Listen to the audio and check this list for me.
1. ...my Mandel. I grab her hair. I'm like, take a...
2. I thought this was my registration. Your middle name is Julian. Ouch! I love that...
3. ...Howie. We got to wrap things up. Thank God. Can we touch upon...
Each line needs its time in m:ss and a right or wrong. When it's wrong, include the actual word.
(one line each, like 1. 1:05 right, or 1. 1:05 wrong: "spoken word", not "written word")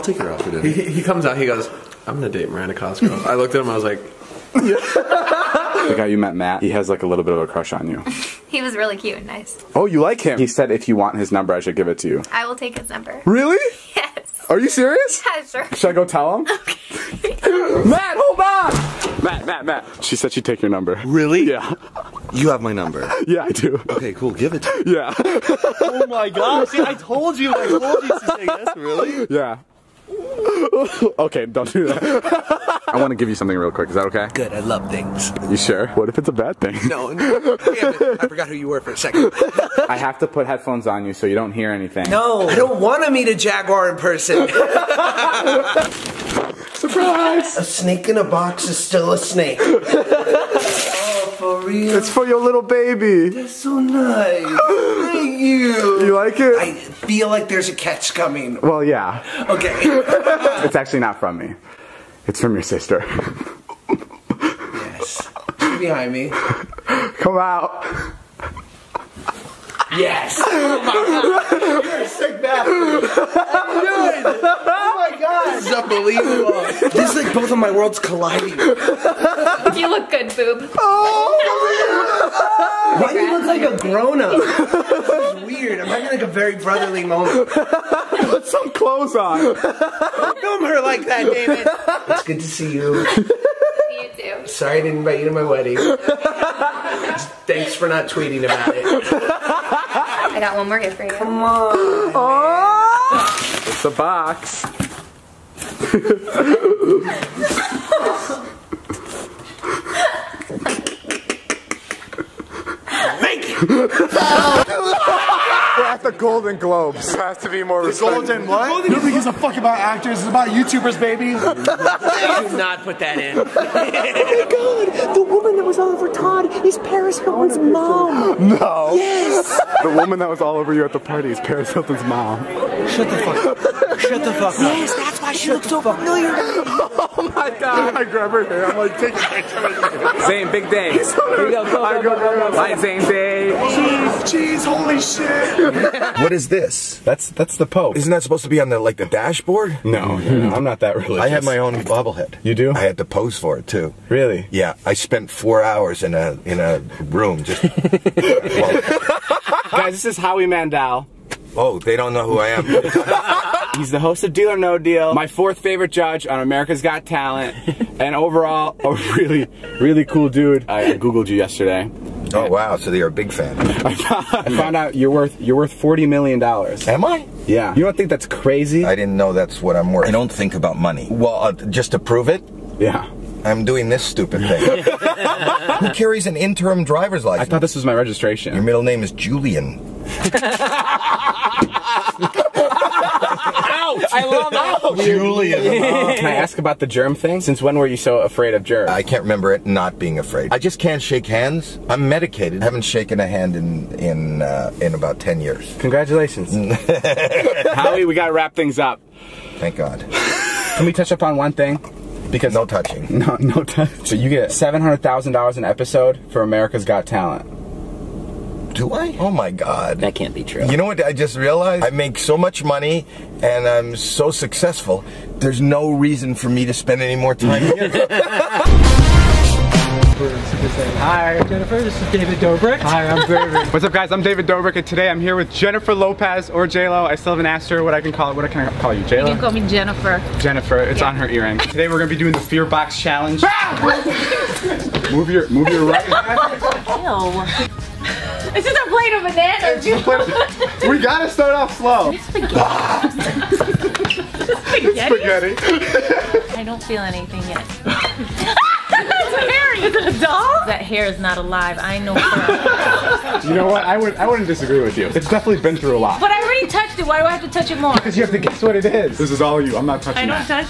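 1. 2:17 wrong: "God", not "Mandel"
2. 3:07 right
3. 3:27 right.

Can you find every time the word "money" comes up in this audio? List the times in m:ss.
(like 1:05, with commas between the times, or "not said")
3:00, 3:42.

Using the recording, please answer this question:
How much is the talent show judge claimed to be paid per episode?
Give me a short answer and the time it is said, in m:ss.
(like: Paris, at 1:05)
$700,000, at 3:34.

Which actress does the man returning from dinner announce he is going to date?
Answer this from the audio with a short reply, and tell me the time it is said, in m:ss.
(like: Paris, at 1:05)
Miranda Cosgrove, at 0:02.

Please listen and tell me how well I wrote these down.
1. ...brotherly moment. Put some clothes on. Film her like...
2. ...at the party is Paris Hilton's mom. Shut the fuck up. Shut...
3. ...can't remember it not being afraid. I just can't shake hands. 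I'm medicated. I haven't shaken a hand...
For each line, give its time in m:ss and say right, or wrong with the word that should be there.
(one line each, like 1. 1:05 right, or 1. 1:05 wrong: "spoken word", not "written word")
1. 1:26 right
2. 2:10 right
3. 3:19 right.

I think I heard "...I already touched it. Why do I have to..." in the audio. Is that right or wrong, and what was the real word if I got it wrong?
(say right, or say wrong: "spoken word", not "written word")
right.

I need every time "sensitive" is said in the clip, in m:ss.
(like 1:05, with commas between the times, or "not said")
not said.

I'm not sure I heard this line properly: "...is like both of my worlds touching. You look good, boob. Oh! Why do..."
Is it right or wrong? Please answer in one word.
wrong.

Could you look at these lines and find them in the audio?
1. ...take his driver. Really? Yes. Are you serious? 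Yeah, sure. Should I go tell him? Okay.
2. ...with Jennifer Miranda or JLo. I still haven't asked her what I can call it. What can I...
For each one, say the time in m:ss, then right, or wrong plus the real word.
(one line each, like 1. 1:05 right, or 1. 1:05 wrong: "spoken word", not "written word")
1. 0:12 wrong: "number", not "driver"
2. 3:55 wrong: "Lopez", not "Miranda".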